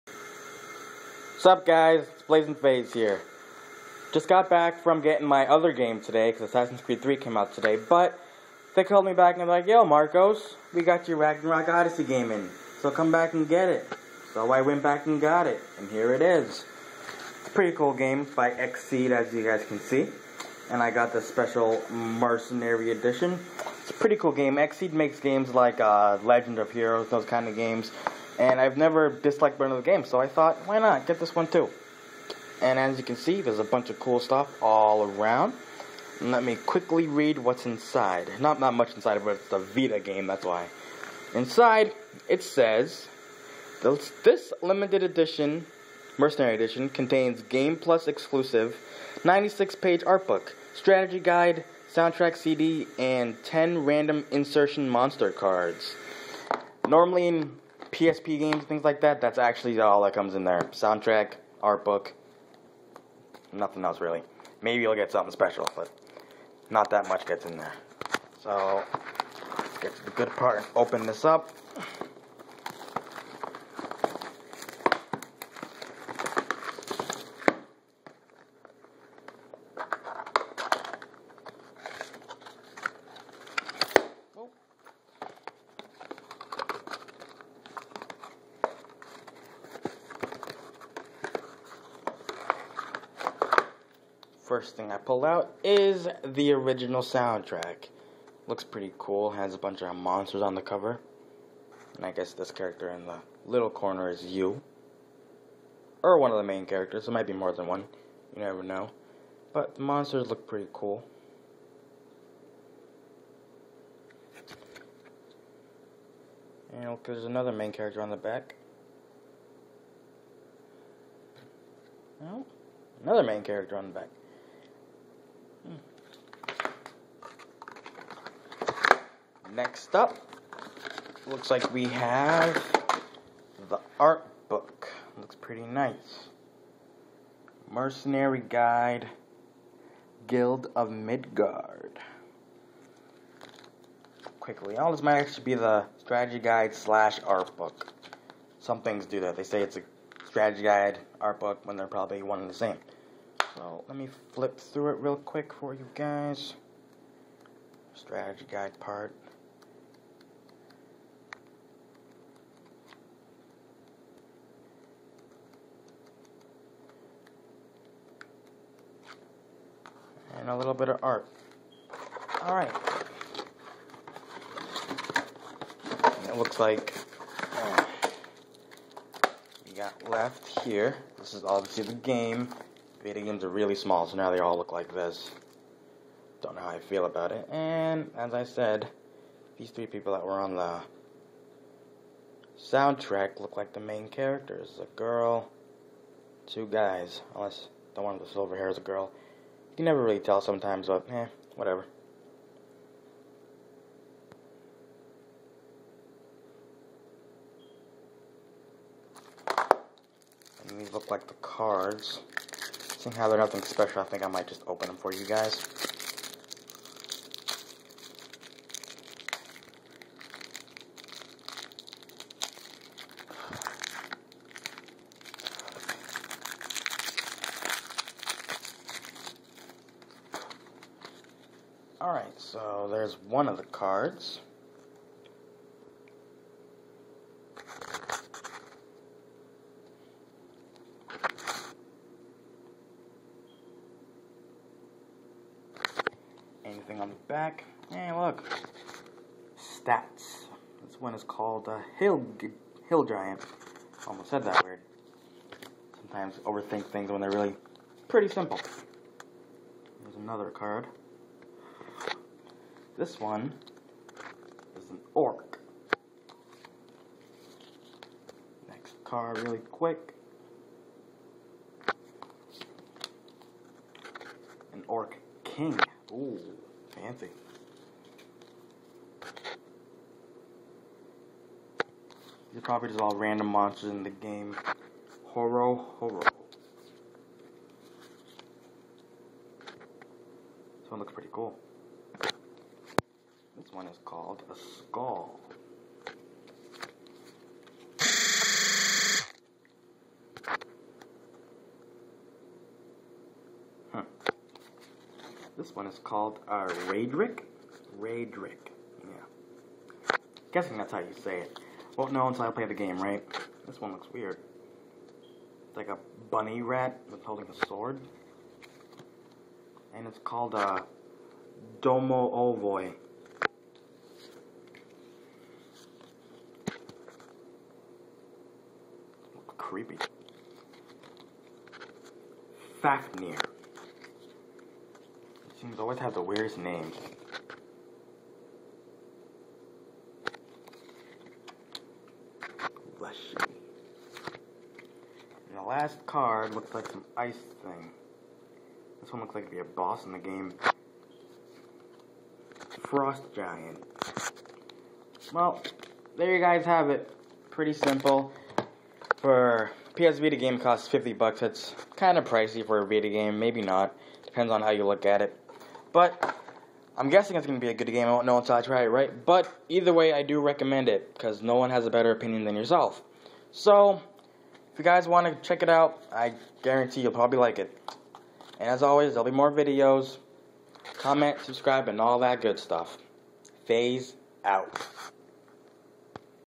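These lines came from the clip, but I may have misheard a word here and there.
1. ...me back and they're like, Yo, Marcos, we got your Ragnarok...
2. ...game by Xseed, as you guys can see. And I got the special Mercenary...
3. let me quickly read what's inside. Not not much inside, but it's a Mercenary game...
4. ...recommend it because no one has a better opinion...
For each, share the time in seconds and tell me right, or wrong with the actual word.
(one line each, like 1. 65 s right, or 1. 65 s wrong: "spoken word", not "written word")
1. 9 s right
2. 17 s right
3. 36 s wrong: "Vita", not "Mercenary"
4. 370 s right.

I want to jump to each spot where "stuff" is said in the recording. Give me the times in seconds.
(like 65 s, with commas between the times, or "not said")
34 s, 382 s.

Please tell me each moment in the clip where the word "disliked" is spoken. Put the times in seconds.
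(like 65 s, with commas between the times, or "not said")
29 s.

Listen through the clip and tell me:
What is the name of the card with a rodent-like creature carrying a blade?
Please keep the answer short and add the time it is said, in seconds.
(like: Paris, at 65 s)
Domovoi, at 321 s.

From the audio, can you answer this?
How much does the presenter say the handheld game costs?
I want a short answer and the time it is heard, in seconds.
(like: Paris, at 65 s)
$50, at 360 s.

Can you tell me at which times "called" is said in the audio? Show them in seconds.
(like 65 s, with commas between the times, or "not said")
8 s, 251 s, 294 s, 306 s, 320 s.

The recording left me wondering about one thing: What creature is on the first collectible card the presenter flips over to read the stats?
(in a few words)
Hill Giant.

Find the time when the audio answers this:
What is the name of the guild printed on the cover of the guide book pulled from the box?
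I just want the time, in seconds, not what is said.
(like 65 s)
140 s.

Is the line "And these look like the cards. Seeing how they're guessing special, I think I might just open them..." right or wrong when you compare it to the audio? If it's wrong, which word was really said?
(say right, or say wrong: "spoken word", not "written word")
wrong: "nothing", not "guessing".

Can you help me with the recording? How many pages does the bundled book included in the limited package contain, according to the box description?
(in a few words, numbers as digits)
96.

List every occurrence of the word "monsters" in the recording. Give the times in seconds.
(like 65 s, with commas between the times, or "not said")
54 s, 99 s, 109 s, 283 s.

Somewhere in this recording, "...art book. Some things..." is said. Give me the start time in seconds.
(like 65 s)
147 s.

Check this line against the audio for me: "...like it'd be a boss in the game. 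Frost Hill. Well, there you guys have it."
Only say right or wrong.
wrong.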